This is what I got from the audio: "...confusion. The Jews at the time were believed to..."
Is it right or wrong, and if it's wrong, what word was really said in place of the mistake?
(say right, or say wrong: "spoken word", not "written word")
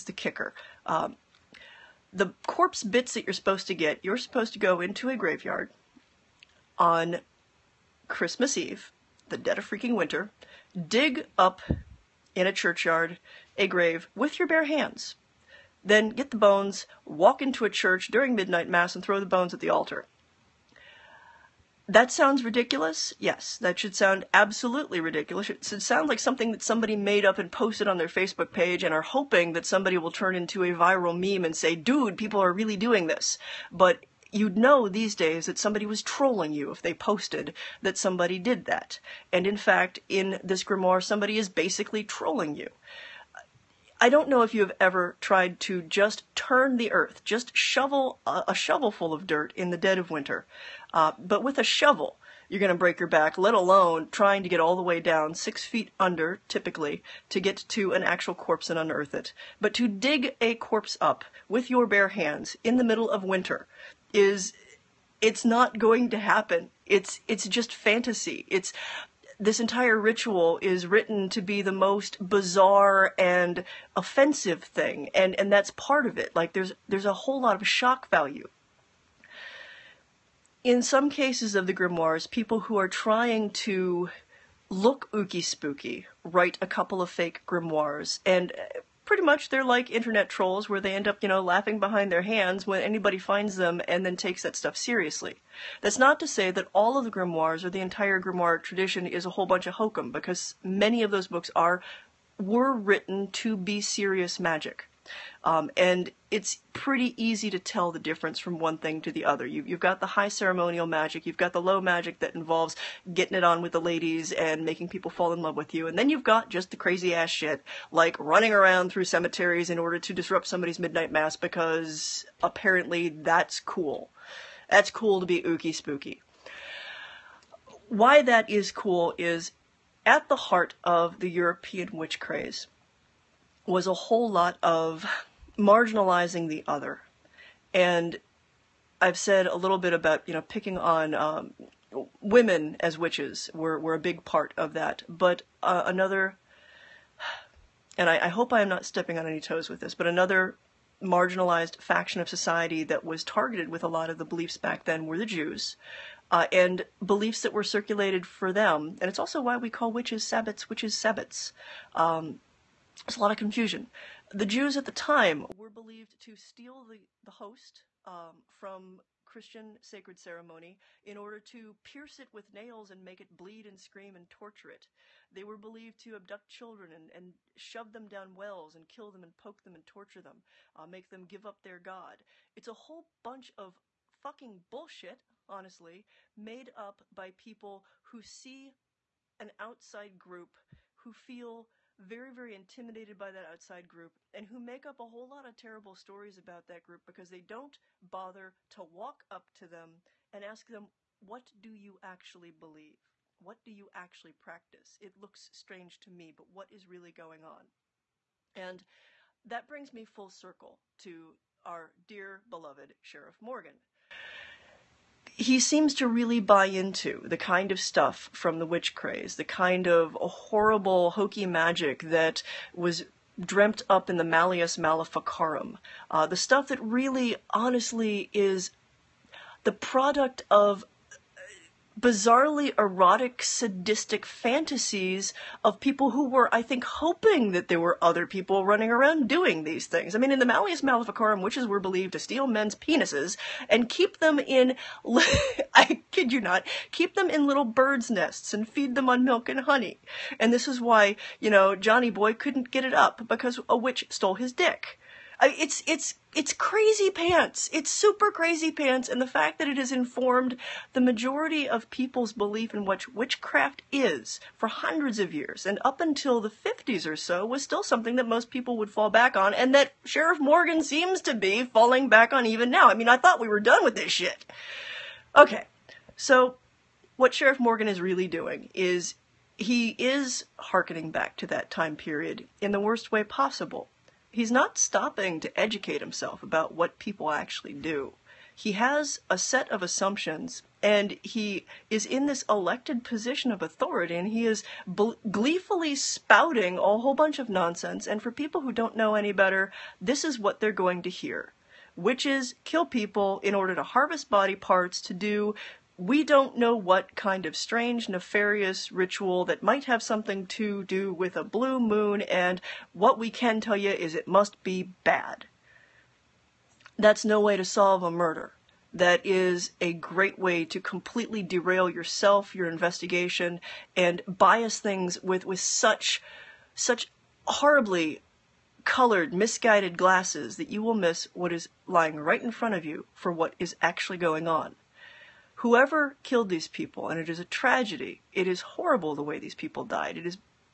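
right.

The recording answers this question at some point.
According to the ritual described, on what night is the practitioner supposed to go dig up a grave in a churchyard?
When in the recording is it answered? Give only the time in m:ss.
0:08.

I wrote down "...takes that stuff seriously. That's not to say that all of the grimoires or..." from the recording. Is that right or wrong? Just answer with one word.
right.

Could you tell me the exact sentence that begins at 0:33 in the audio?
But you'd know these days that somebody was trolling you if they posted that somebody did that.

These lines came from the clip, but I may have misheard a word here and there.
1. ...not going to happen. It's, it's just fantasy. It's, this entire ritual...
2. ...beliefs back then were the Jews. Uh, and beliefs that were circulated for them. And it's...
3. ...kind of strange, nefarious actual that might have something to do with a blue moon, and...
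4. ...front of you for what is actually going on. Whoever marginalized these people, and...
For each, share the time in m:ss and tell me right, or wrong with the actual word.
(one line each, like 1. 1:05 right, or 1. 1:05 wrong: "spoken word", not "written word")
1. 1:05 right
2. 2:34 right
3. 5:07 wrong: "ritual", not "actual"
4. 5:32 wrong: "killed", not "marginalized".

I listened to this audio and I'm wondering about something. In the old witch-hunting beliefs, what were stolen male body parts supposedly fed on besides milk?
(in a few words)
honey.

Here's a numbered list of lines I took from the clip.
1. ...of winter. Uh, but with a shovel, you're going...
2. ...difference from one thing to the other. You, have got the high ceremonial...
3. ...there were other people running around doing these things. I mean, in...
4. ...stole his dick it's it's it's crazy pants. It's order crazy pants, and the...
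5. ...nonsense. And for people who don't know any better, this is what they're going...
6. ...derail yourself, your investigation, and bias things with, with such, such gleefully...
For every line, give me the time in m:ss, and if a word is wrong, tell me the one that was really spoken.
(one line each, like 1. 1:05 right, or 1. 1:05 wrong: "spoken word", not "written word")
1. 0:49 right
2. 1:47 right
3. 3:57 right
4. 4:14 wrong: "super", not "order"
5. 4:57 right
6. 5:21 wrong: "horribly", not "gleefully".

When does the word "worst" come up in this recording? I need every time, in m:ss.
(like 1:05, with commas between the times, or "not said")
4:42.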